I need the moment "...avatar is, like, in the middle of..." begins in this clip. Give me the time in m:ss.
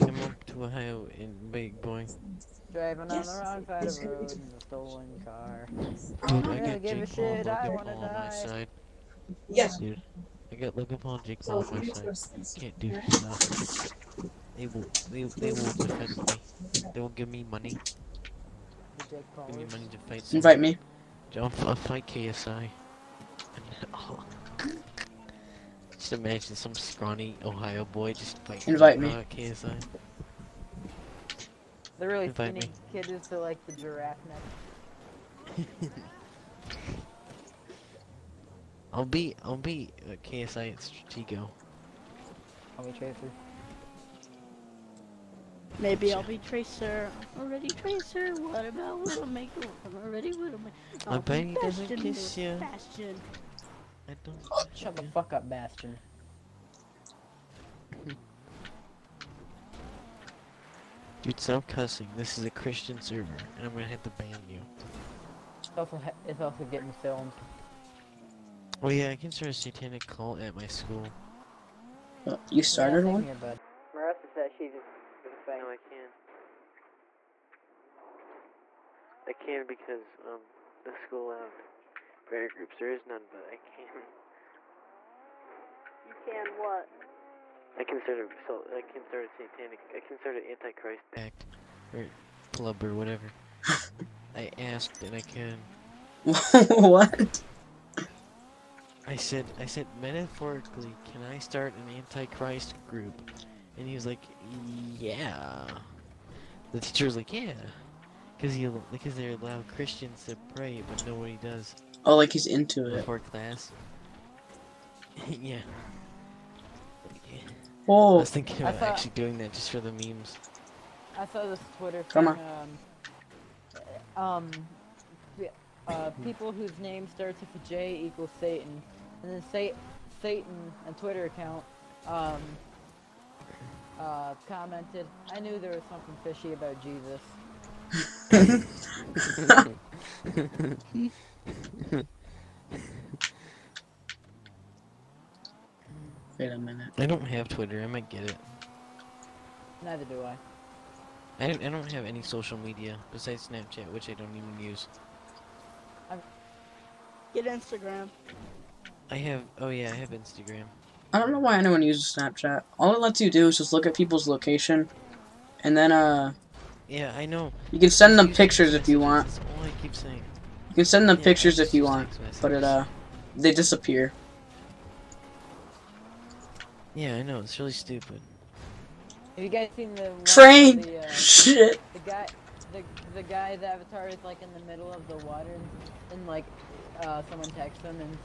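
3:03.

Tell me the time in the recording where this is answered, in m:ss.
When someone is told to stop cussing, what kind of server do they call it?
1:02.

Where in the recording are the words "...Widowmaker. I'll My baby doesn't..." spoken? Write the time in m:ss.
0:50.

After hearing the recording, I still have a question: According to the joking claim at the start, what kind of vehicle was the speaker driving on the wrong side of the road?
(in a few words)
stolen car.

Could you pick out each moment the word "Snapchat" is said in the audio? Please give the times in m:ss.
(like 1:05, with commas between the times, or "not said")
2:33, 2:42.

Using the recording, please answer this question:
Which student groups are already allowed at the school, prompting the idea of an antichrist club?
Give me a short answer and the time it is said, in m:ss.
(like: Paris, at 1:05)
prayer groups, at 1:22.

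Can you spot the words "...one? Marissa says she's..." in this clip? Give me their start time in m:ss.
1:13.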